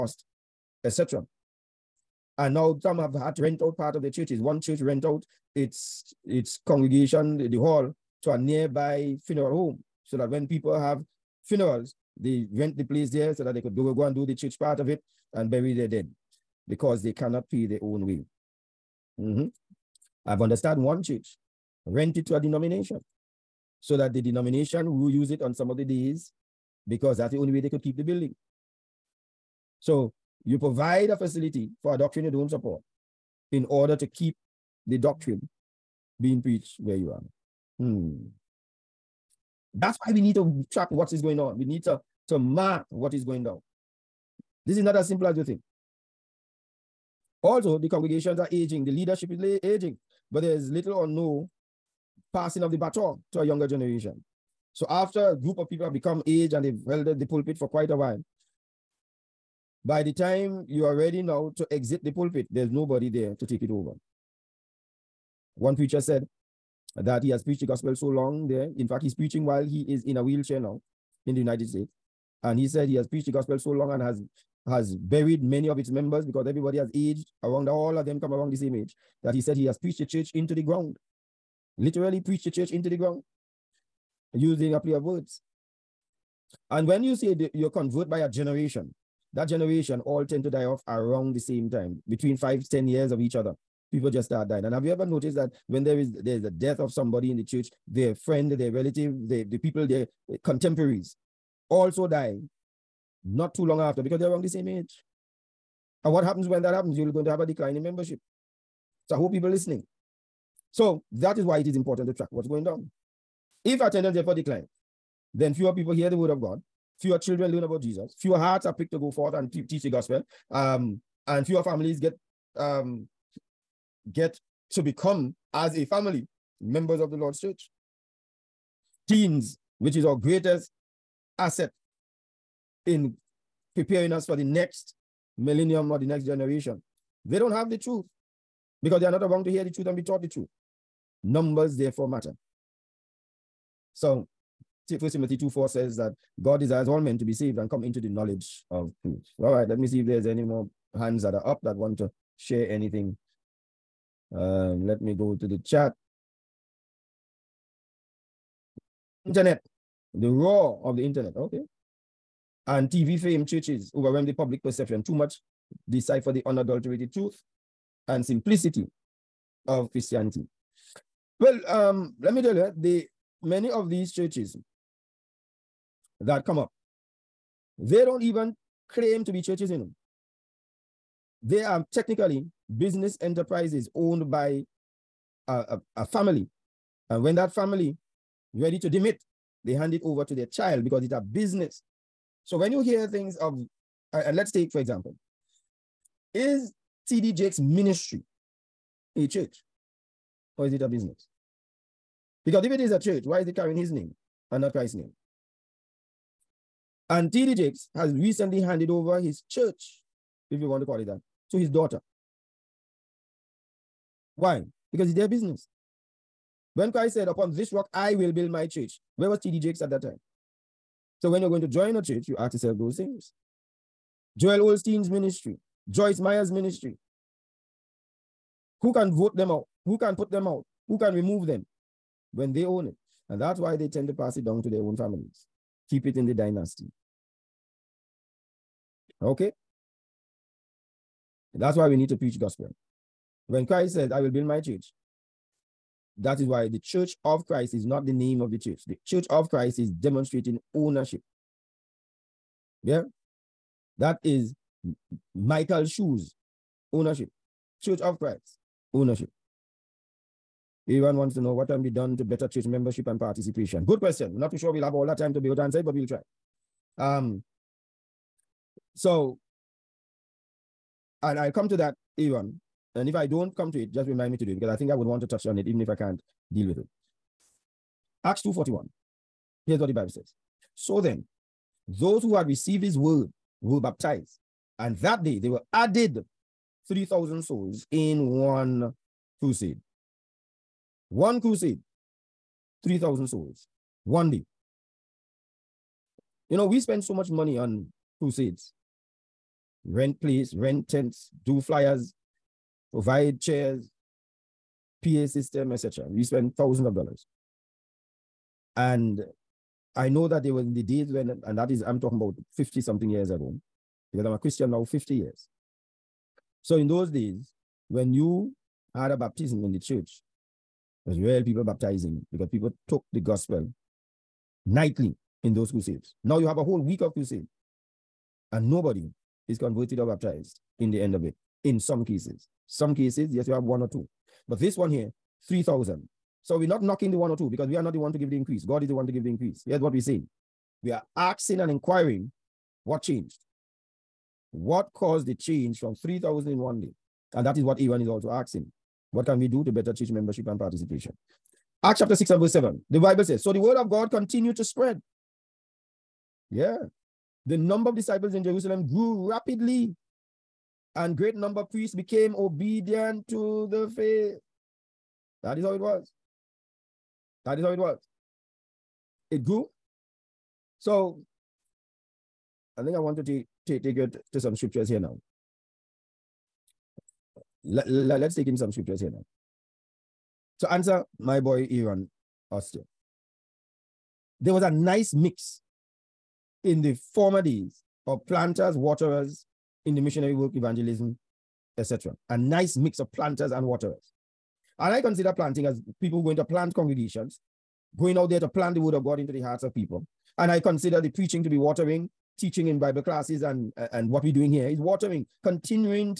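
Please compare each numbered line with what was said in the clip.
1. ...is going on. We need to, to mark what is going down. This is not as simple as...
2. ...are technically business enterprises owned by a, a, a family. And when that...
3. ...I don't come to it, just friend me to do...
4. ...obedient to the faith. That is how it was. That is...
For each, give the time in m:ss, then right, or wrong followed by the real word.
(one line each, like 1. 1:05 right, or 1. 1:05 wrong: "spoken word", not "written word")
1. 0:41 right
2. 3:01 right
3. 4:33 wrong: "remind", not "friend"
4. 6:02 right.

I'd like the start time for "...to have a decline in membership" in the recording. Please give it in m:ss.
1:47.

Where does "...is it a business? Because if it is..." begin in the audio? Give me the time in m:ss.
3:20.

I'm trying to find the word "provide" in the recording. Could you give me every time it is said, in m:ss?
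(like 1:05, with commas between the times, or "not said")
0:30, 5:02.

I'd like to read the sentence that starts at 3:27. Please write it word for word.
And TD Jakes has recently handed over his church, if you want to call it that, to his daughter.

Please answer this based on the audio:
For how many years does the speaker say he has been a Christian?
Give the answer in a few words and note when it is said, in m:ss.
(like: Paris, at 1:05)
50 years, at 5:14.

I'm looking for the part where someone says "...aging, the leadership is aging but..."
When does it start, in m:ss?
0:48.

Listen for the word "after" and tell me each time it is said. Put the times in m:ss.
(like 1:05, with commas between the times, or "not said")
0:54, 1:43.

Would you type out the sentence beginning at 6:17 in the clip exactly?
Let, let, let's take in some scriptures here now.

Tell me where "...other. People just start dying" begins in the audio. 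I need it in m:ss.
1:33.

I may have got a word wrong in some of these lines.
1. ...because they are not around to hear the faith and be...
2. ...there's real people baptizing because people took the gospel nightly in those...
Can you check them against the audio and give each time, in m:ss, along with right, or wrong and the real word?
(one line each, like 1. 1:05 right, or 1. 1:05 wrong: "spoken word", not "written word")
1. 2:18 wrong: "truth", not "faith"
2. 5:21 right.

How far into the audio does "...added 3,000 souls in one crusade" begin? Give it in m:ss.
4:45.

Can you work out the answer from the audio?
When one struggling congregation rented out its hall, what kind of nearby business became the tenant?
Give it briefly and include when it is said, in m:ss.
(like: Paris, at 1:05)
funeral home, at 0:09.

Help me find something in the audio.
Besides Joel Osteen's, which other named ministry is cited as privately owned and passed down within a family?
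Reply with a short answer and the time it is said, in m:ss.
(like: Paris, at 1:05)
Joyce Meyer's ministry, at 3:45.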